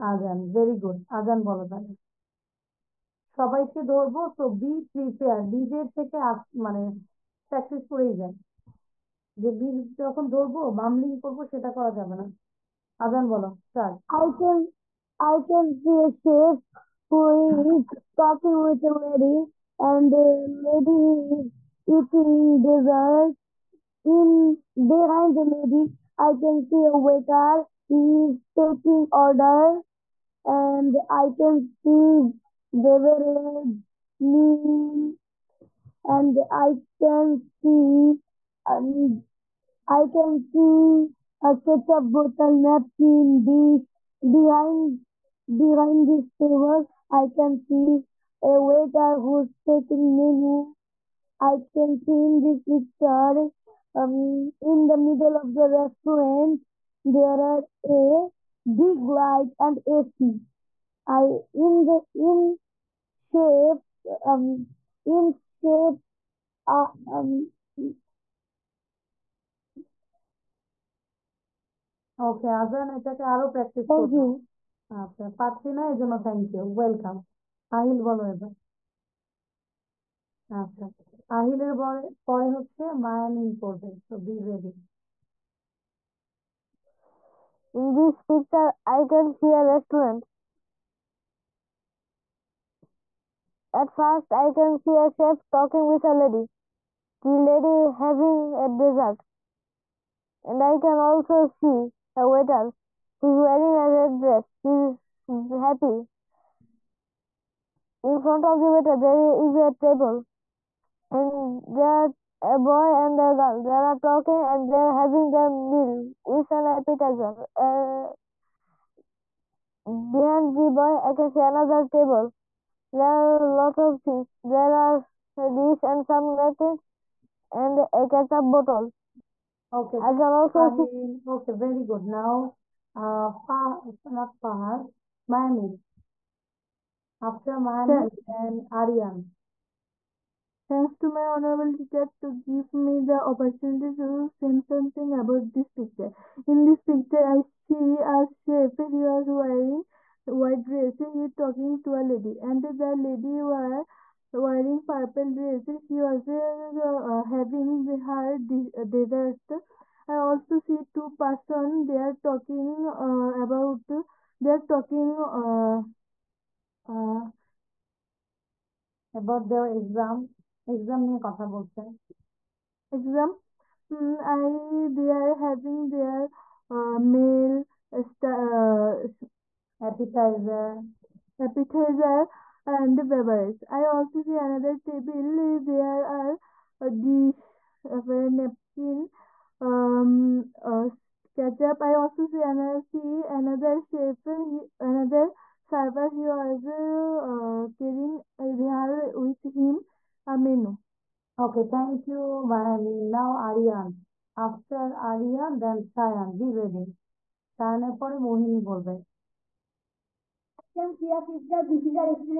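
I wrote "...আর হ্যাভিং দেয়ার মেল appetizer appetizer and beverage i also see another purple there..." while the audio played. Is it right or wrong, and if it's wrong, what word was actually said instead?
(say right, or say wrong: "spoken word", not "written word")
wrong: "table", not "purple".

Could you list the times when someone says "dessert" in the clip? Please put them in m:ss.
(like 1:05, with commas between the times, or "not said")
0:22, 1:38, 2:38.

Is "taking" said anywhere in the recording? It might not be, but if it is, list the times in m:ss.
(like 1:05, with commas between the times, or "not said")
0:28, 0:49.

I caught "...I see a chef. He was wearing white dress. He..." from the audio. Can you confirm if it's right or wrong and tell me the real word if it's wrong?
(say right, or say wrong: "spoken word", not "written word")
right.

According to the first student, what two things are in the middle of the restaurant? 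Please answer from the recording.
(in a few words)
a big light and AC.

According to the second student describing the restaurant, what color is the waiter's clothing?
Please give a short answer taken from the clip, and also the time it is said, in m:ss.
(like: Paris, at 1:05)
red, at 1:43.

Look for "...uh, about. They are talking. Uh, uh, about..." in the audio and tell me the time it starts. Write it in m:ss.
2:42.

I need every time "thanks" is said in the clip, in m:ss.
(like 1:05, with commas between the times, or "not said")
2:20, 3:21.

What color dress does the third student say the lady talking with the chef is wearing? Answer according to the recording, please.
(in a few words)
purple.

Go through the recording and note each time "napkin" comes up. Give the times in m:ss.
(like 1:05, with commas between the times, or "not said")
0:42, 2:06, 3:08.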